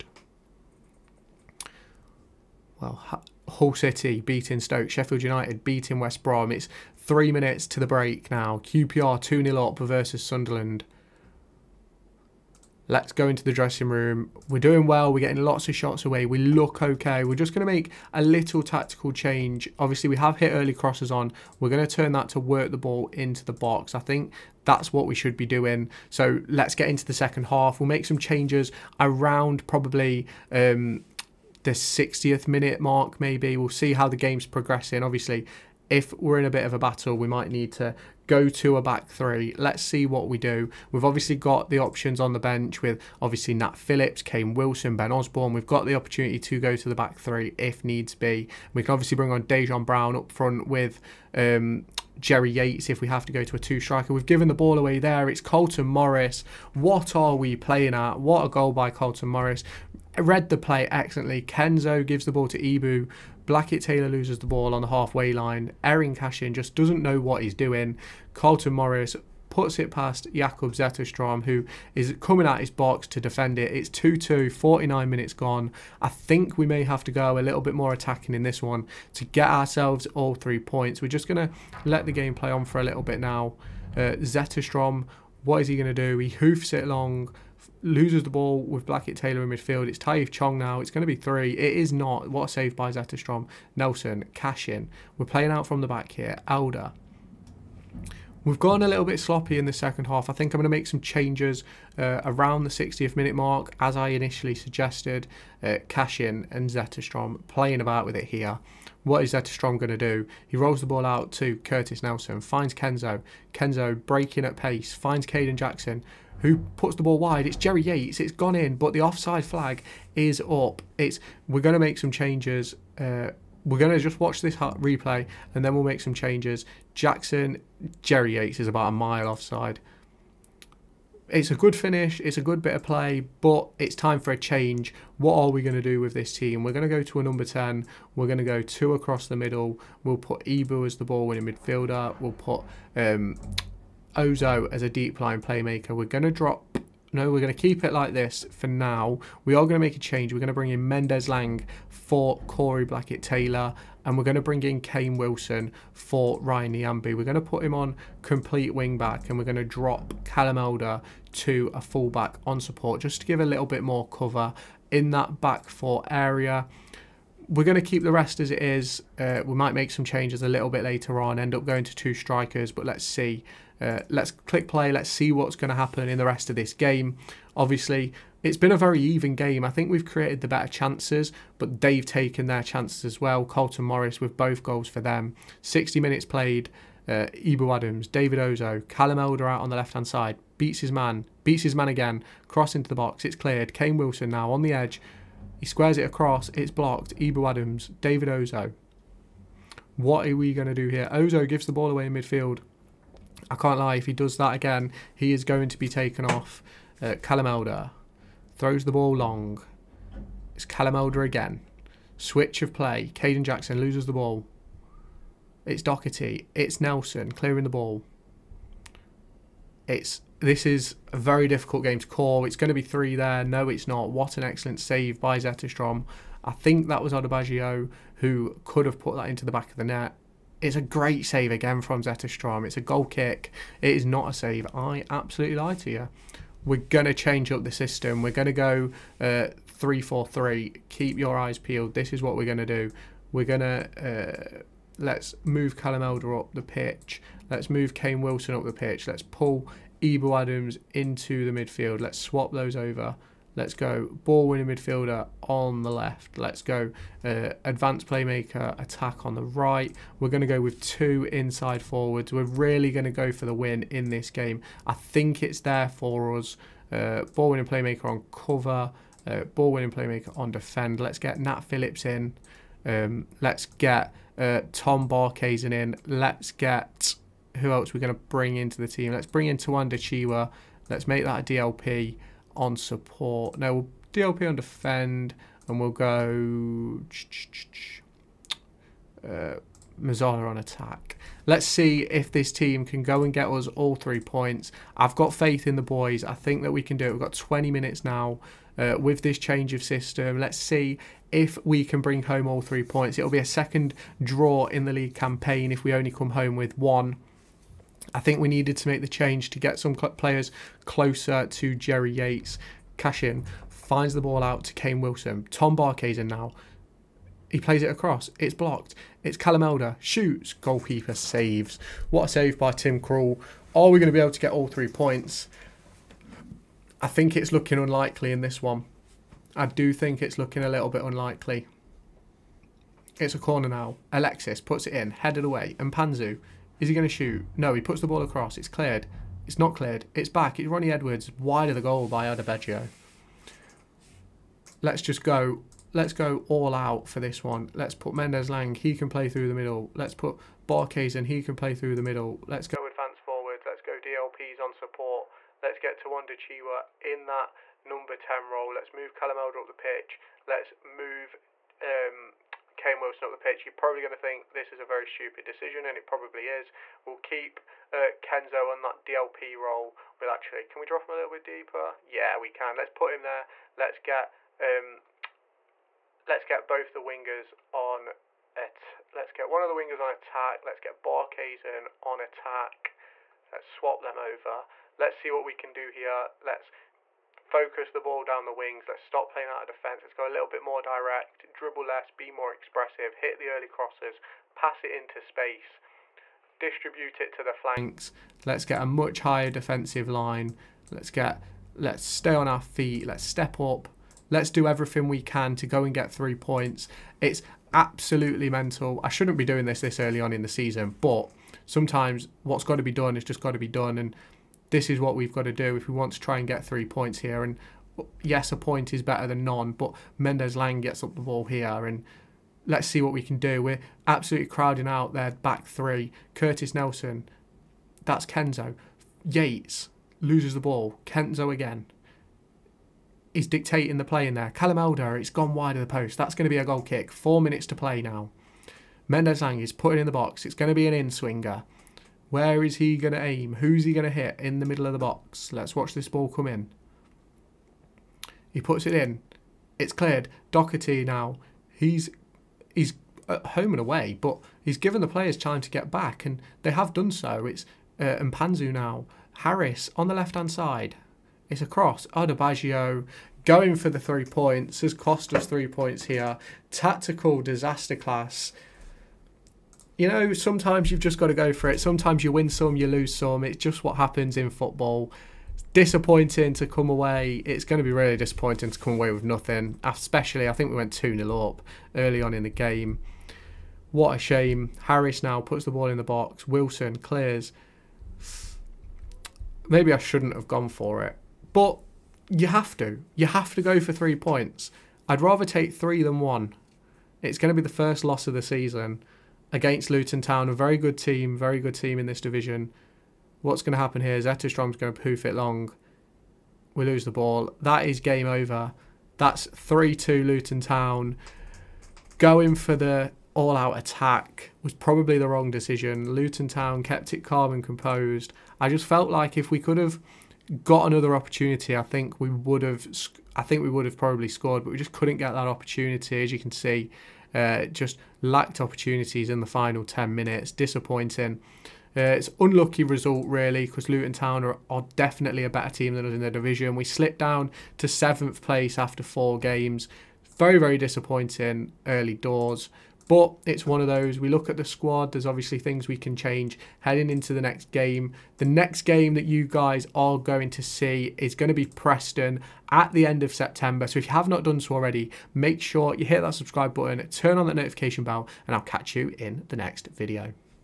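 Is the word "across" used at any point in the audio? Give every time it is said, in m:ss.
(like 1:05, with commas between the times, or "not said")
2:18, 3:16, 5:17, 5:38.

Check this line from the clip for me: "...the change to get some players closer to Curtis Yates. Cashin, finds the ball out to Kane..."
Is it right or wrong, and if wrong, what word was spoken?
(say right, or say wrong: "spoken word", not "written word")
wrong: "Jerry", not "Curtis".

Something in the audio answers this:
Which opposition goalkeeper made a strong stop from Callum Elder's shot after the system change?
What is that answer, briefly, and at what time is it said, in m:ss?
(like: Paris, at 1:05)
Tim Krul, at 5:22.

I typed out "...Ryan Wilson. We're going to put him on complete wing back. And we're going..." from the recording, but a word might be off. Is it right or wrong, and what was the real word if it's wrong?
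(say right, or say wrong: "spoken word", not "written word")
wrong: "Nyambe", not "Wilson".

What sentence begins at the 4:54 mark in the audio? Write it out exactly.
I've got faith in the boys.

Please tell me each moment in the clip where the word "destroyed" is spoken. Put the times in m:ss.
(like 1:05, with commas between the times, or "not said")
not said.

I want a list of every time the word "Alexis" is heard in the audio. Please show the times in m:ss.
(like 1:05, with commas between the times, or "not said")
5:34.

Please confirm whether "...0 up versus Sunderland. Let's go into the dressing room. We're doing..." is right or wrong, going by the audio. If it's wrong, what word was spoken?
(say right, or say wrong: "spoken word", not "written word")
right.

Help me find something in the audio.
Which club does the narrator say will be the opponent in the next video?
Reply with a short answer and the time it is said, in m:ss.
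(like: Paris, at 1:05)
Preston, at 9:11.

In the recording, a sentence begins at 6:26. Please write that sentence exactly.
Let's focus the ball down the wings.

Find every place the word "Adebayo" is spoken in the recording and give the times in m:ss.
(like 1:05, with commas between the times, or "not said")
3:47, 5:42.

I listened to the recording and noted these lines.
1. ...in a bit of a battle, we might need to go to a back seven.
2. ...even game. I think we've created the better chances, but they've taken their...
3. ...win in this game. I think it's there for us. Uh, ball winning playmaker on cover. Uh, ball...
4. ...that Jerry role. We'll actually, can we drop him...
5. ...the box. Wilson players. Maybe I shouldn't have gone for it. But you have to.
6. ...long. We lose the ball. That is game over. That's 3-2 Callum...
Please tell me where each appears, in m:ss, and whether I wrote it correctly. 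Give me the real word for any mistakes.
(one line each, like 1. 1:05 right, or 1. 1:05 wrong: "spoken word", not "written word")
1. 0:36 wrong: "three", not "seven"
2. 2:59 right
3. 4:23 right
4. 6:08 wrong: "DLP", not "Jerry"
5. 8:05 wrong: "clears", not "players"
6. 8:25 wrong: "Luton", not "Callum".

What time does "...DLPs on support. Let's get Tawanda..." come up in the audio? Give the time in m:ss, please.
5:53.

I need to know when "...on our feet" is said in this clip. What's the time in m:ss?
6:42.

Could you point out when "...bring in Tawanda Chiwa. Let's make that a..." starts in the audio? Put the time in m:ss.
4:39.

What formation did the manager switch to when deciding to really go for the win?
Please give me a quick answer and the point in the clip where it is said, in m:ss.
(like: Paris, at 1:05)
3-4-3, at 3:59.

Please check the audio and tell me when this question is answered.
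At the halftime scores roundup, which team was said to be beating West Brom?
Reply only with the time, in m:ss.
0:04.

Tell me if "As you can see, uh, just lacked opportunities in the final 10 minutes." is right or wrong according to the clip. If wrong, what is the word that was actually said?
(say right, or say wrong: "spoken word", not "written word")
right.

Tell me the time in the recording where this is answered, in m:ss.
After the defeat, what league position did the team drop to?
8:57.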